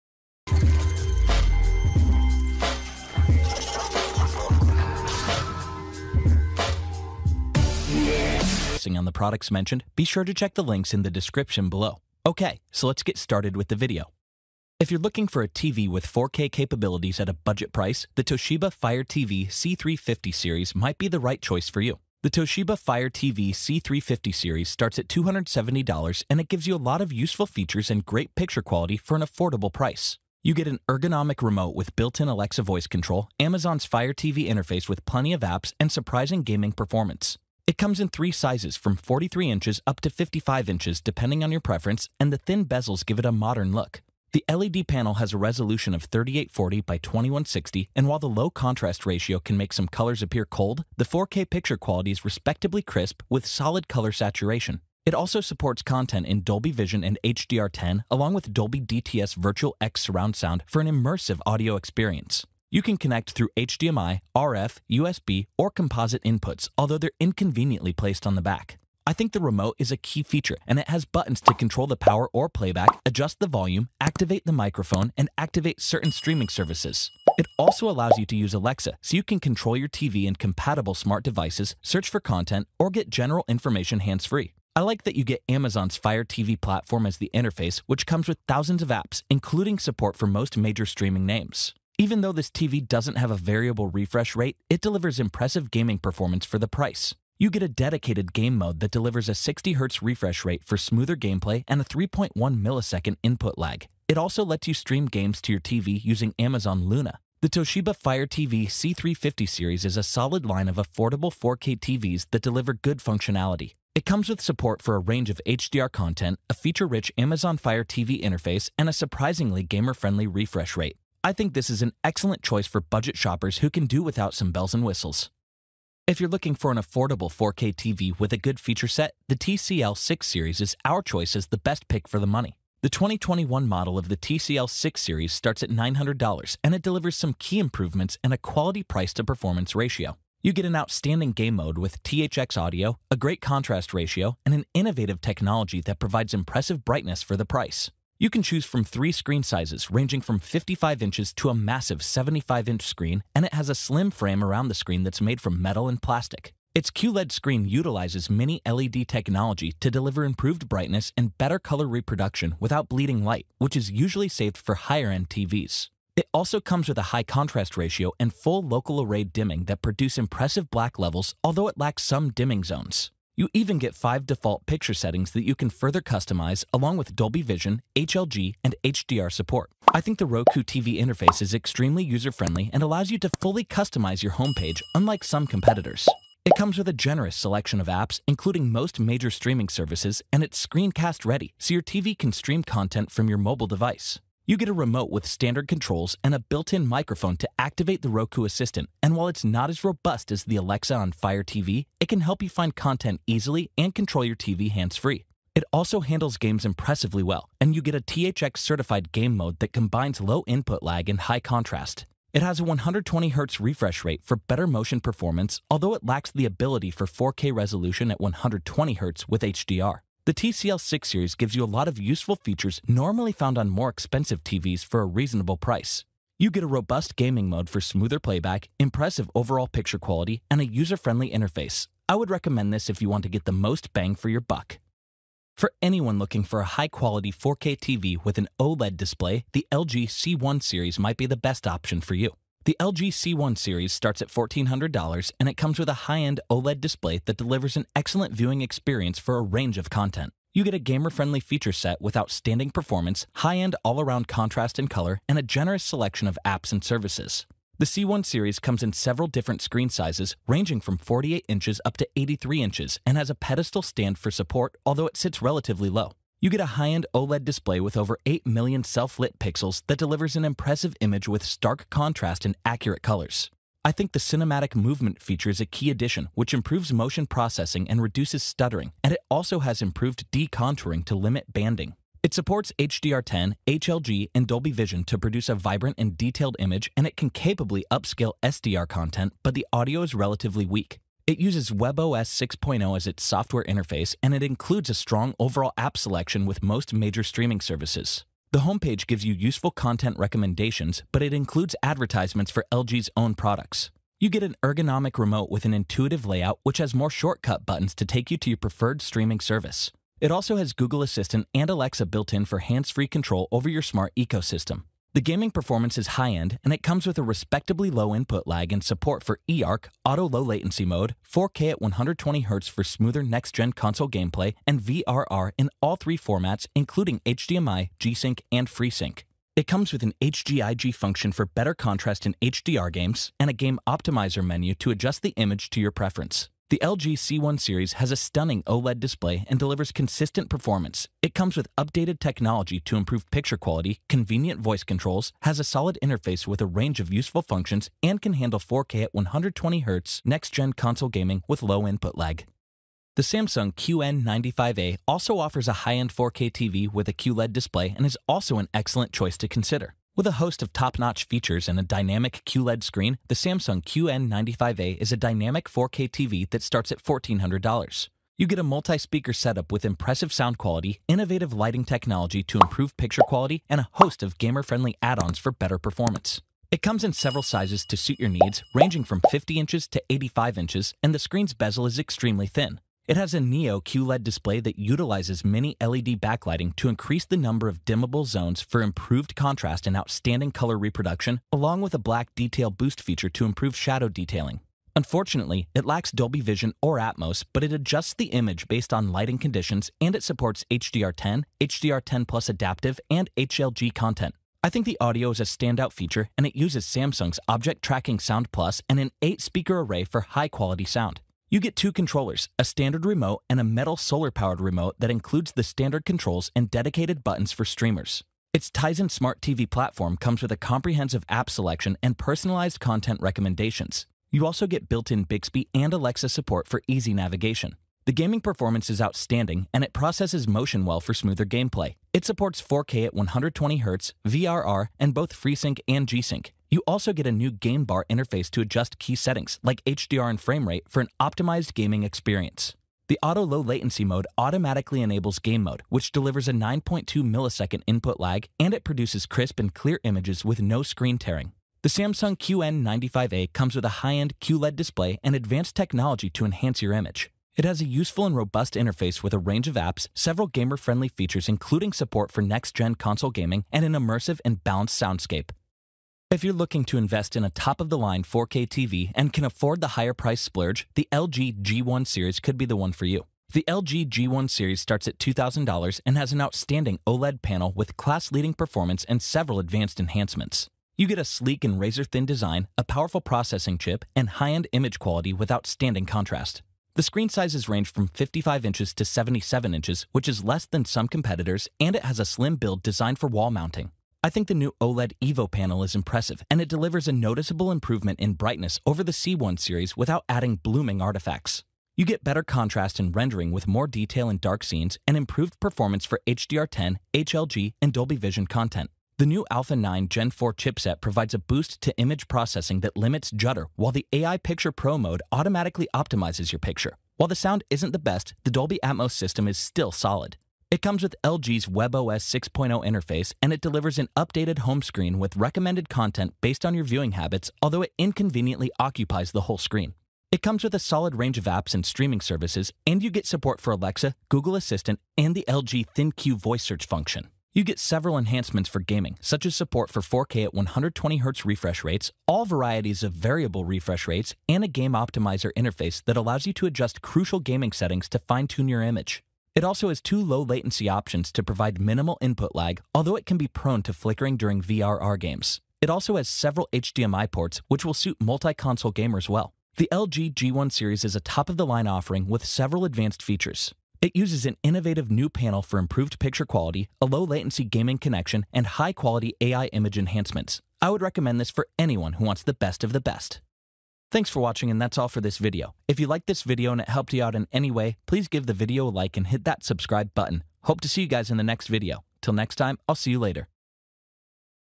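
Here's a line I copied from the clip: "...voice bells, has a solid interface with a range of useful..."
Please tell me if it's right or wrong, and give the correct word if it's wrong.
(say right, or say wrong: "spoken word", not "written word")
wrong: "controls", not "bells".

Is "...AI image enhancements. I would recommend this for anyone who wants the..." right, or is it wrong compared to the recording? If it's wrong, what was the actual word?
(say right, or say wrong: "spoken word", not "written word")
right.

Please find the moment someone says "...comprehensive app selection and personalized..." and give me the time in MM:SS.
07:00.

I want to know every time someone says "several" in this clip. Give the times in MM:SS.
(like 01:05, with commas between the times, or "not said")
04:18, 06:17, 07:40, 07:59, 08:57, 09:16, 09:22.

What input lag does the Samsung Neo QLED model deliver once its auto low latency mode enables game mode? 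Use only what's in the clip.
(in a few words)
9.2 milliseconds.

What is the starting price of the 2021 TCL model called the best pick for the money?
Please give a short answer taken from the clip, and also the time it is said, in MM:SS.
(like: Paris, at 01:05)
$900, at 02:15.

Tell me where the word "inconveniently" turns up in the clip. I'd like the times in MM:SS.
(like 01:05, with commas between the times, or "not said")
01:07, 08:47.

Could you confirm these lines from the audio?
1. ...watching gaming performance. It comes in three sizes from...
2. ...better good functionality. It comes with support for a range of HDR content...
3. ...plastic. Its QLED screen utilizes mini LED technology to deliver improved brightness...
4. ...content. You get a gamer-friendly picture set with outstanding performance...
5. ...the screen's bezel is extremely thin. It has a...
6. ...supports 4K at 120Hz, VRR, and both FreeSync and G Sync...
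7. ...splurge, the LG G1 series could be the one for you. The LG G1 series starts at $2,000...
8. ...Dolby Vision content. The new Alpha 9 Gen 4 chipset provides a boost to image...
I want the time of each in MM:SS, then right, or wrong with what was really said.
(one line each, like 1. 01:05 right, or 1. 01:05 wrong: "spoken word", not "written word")
1. 00:35 wrong: "surprising", not "watching"
2. 01:52 wrong: "deliver", not "better"
3. 02:35 right
4. 04:09 wrong: "feature", not "picture"
5. 06:21 right
6. 07:12 right
7. 07:50 right
8. 08:27 right.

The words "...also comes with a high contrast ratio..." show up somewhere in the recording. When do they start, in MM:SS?
02:46.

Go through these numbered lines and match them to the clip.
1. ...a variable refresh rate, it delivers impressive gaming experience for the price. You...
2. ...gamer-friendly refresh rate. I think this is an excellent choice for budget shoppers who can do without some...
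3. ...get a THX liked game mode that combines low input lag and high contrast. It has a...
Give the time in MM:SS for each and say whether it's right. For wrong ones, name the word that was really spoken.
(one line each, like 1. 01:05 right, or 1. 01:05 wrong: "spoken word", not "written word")
1. 01:33 wrong: "performance", not "experience"
2. 01:59 right
3. 03:27 wrong: "certified", not "liked".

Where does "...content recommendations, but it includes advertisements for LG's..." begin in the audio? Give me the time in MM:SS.
04:59.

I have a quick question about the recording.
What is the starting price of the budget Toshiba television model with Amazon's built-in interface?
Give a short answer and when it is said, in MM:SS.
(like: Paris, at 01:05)
$270, at 00:25.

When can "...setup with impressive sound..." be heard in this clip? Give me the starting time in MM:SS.
06:09.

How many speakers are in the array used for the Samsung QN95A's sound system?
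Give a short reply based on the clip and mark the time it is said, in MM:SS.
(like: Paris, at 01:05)
8, at 06:49.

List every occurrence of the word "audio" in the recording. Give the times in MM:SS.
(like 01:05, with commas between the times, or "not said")
01:01, 02:22, 04:49, 06:45.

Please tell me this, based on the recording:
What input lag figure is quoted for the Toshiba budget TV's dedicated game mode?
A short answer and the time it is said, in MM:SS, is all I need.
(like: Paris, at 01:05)
3.1 milliseconds, at 01:41.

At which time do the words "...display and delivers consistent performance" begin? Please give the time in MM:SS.
05:39.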